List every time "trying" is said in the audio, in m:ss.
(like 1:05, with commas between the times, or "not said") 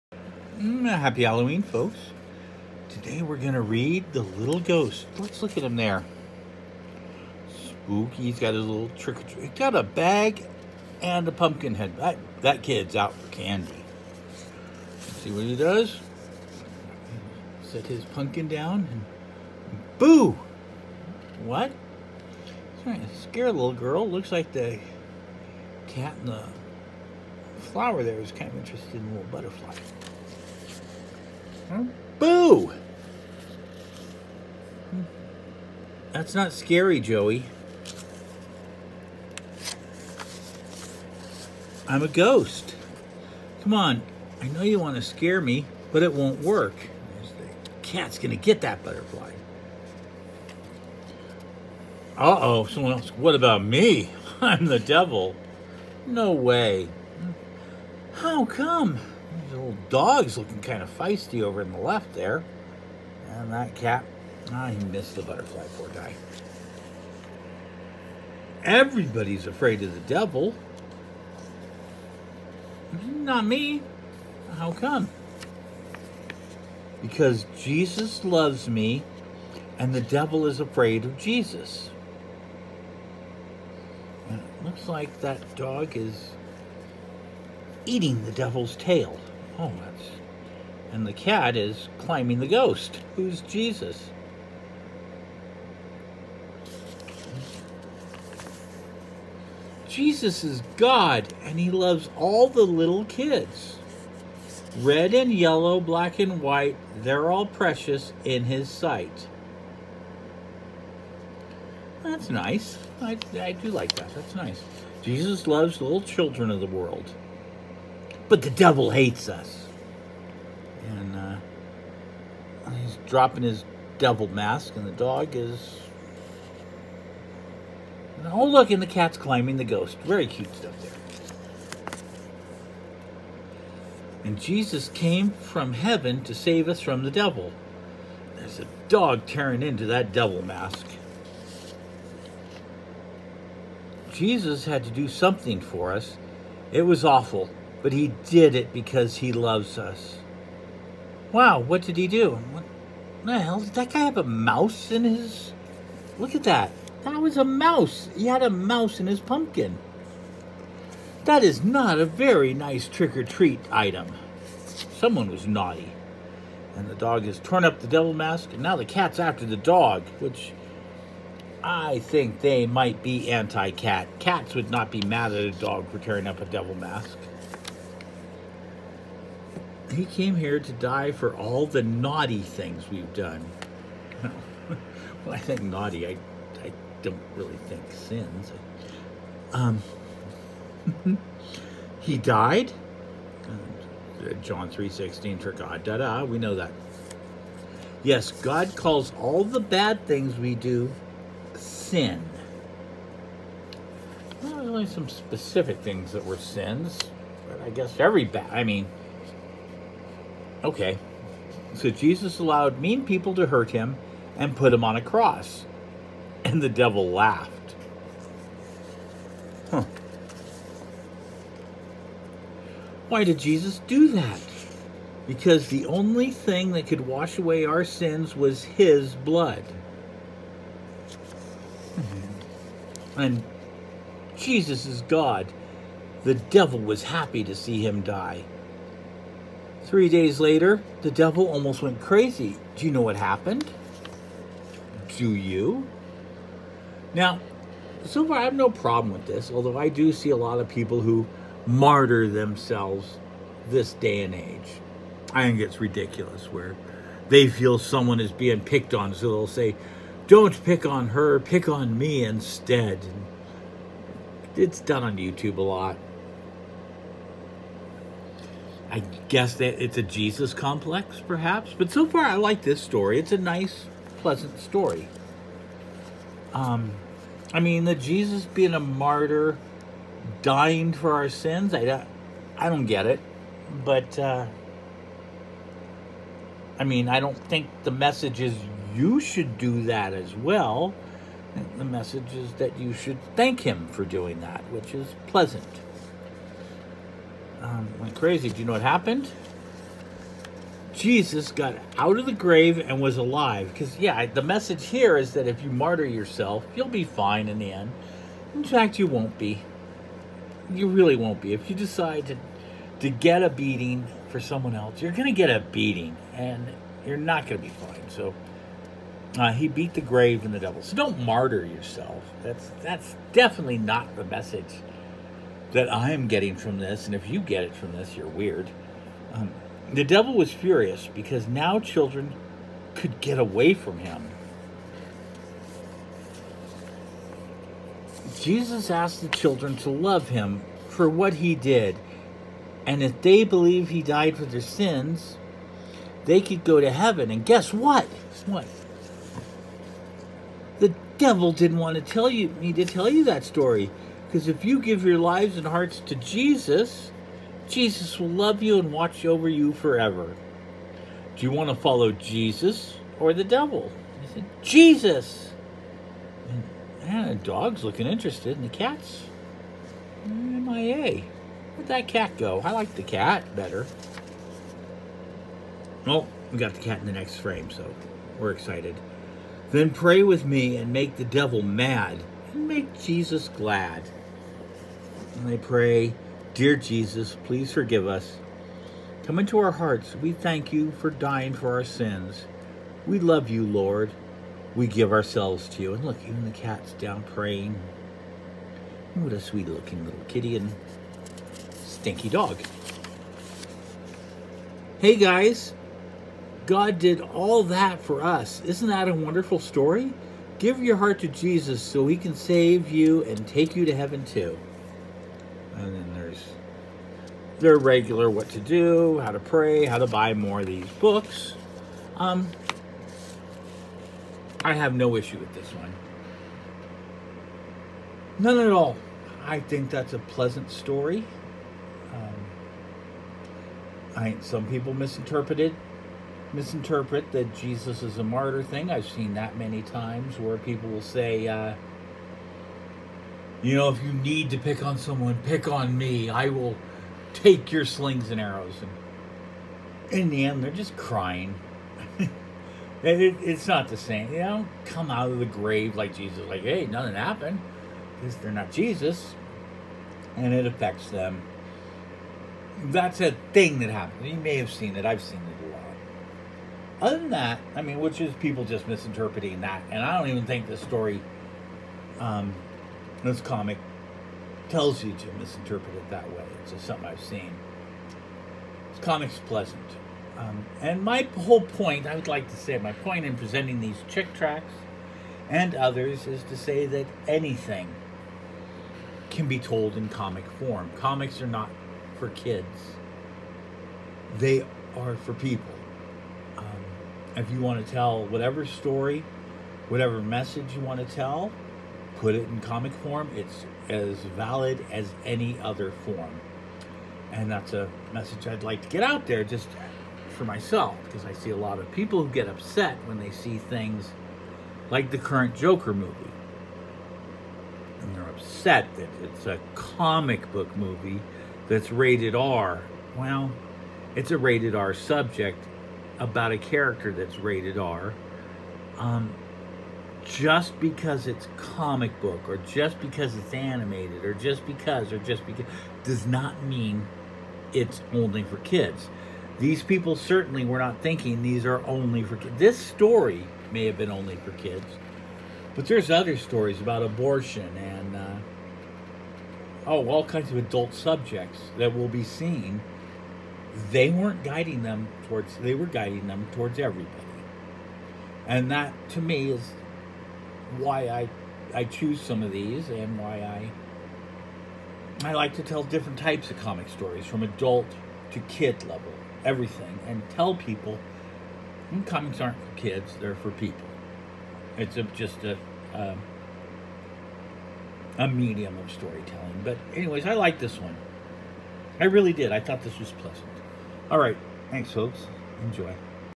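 0:22.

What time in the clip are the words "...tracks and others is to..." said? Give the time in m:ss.
8:04.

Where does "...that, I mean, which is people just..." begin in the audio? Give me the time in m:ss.
7:47.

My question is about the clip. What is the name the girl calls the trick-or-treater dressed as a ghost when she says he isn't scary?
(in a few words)
Joey.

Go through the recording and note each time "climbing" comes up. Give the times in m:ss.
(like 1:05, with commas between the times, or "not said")
1:31, 2:09.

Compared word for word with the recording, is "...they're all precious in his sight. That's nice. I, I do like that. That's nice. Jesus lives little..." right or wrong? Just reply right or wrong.
wrong.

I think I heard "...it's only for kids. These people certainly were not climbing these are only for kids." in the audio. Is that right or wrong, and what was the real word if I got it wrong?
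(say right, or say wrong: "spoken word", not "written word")
wrong: "thinking", not "climbing".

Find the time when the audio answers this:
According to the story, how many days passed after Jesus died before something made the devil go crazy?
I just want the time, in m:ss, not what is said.
3:59.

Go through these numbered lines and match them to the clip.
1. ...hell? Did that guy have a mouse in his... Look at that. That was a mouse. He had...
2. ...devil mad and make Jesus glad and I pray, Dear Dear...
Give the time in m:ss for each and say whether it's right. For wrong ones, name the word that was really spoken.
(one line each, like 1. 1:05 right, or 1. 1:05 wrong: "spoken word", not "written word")
1. 2:33 right
2. 6:21 wrong: "Jesus", not "Dear".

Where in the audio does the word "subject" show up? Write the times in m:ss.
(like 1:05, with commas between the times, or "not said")
8:44, 9:10.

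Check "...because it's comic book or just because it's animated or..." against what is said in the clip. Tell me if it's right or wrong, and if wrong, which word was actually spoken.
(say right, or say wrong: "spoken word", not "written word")
right.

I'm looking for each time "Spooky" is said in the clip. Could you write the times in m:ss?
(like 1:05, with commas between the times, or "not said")
0:07.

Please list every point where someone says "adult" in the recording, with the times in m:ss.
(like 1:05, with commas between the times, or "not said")
9:10, 9:27.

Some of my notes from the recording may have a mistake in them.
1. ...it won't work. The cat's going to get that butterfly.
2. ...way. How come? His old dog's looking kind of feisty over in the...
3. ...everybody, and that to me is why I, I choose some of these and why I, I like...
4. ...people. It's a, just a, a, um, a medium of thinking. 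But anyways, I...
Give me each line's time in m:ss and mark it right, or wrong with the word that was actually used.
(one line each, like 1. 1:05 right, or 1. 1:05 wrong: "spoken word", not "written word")
1. 0:46 right
2. 0:56 right
3. 9:16 right
4. 9:33 wrong: "storytelling", not "thinking".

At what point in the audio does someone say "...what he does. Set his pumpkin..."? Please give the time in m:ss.
0:15.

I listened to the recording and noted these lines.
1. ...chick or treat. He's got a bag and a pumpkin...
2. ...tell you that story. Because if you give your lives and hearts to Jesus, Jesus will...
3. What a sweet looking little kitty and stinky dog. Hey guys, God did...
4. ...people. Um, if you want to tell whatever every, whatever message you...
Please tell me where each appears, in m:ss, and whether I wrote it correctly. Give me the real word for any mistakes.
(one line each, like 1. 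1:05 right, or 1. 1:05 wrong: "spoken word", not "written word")
1. 0:08 wrong: "trick", not "chick"
2. 5:52 right
3. 6:39 right
4. 8:15 wrong: "story", not "every".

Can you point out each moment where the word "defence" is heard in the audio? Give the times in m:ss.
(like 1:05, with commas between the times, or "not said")
not said.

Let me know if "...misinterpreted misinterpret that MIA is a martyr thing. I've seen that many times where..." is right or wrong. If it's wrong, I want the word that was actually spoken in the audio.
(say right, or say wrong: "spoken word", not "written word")
wrong: "Jesus", not "MIA".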